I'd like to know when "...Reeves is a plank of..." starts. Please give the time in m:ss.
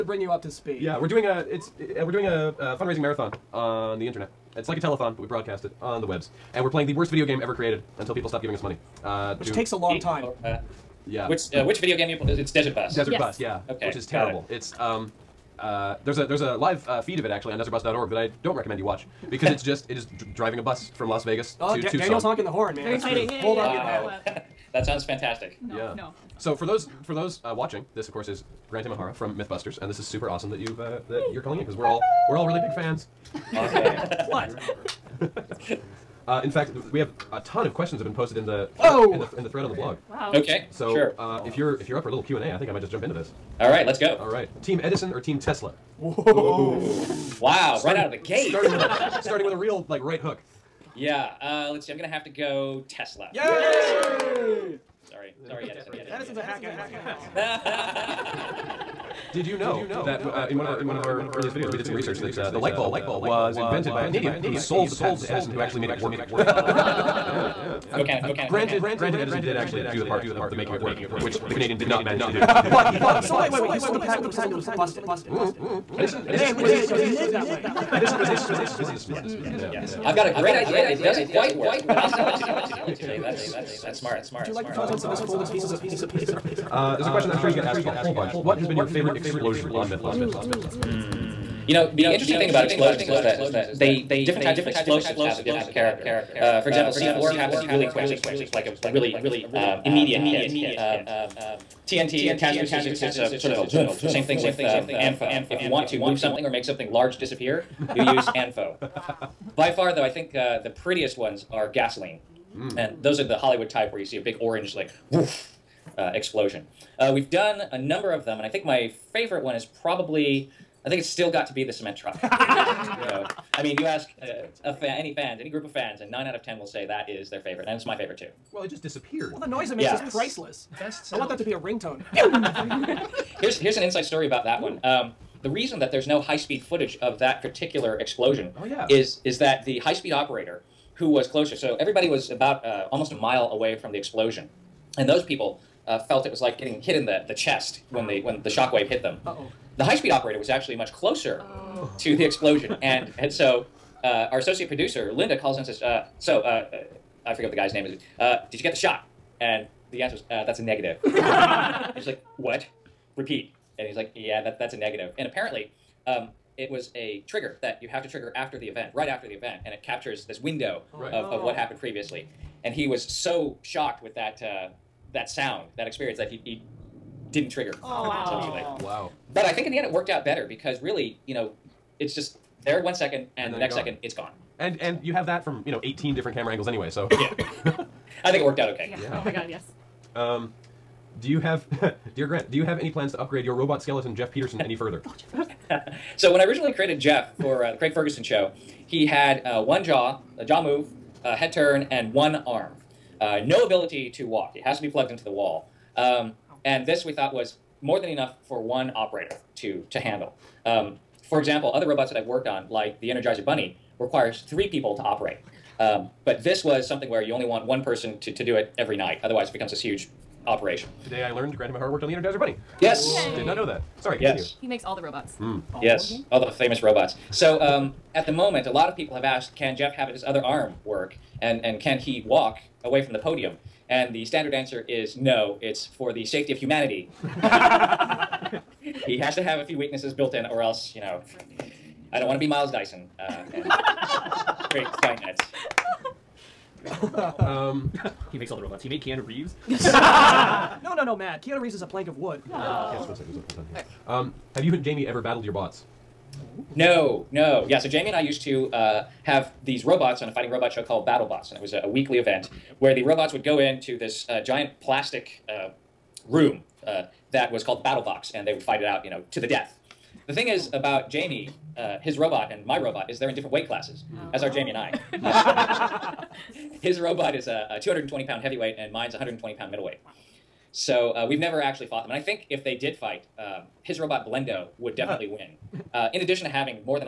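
4:11.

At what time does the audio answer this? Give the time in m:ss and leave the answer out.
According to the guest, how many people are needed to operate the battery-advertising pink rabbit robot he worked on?
3:34.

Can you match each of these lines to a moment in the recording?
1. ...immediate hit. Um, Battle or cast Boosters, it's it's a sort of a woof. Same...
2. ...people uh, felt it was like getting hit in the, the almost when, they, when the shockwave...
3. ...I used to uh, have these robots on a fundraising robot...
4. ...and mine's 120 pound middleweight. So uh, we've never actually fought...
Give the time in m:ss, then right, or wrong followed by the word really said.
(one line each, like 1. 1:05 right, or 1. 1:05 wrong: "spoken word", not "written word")
1. 1:39 wrong: "TNT", not "Battle"
2. 2:25 wrong: "chest", not "almost"
3. 4:18 wrong: "fighting", not "fundraising"
4. 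4:38 right.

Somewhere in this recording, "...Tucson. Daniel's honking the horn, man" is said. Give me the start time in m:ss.
0:21.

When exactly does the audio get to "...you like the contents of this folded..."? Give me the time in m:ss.
1:24.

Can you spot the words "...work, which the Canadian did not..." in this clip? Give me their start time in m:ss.
1:11.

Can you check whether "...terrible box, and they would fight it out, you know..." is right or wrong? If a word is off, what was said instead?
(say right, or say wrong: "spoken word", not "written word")
wrong: "battle", not "terrible".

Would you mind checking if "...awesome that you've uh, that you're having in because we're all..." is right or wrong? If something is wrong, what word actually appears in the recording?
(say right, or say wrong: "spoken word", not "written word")
wrong: "calling", not "having".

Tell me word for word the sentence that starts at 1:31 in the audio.
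You know, the interesting thing about explosions is that they different types of explosives have a different character.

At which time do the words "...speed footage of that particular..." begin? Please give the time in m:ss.
2:16.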